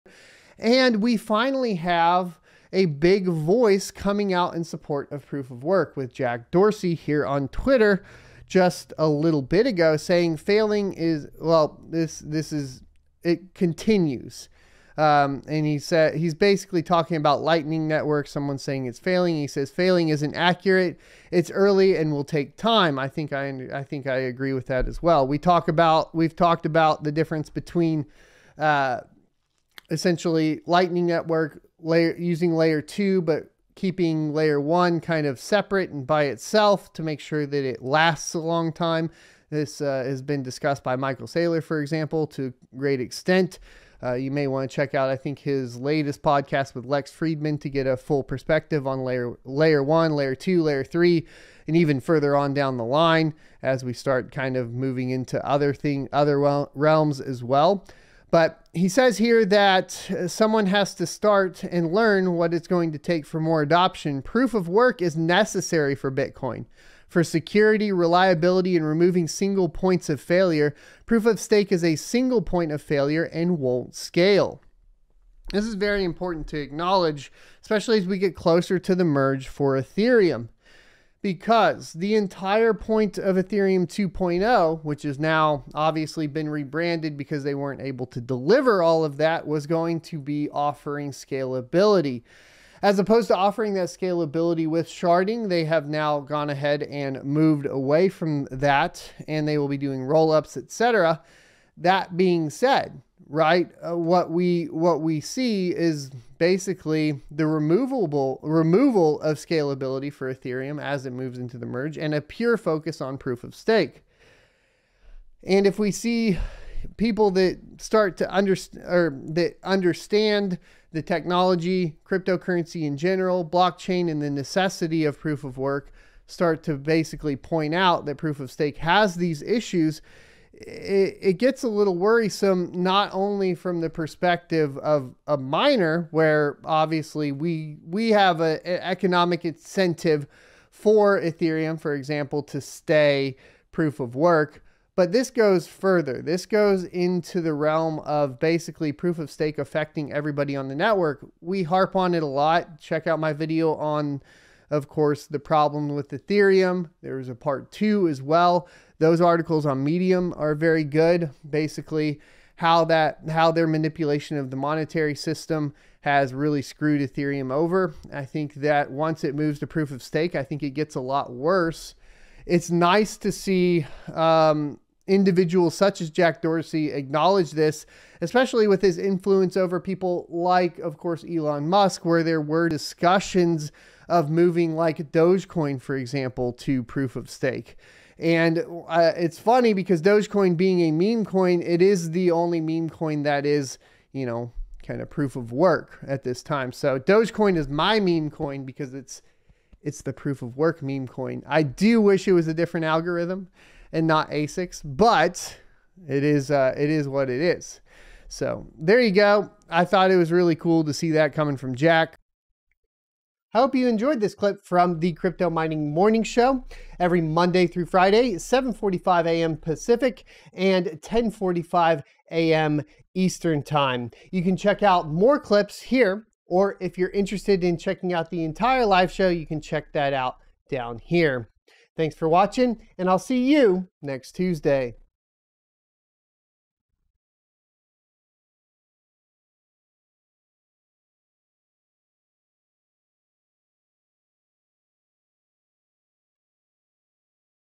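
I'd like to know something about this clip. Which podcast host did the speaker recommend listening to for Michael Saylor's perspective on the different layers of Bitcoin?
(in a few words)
Lex Fridman.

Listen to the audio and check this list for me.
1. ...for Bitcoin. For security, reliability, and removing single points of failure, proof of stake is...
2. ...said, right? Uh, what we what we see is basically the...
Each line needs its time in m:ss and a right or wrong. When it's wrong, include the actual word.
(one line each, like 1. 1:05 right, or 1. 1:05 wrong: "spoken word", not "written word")
1. 1:05 right
2. 1:42 right.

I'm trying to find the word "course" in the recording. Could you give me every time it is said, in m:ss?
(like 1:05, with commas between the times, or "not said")
2:34, 3:00.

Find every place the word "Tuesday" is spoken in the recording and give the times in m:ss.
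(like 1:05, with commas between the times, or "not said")
3:54.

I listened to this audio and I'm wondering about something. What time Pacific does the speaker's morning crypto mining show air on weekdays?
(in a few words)
7:45 a.m.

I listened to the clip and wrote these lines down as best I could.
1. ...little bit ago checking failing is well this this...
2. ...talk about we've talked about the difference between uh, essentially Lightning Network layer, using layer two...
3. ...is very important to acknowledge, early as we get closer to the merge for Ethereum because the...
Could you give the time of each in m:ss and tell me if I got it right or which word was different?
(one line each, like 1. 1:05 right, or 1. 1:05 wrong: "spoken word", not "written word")
1. 0:09 wrong: "saying", not "checking"
2. 0:25 right
3. 1:15 wrong: "especially", not "early".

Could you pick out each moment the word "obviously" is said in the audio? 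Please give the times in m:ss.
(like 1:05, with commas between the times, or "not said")
1:25, 2:16.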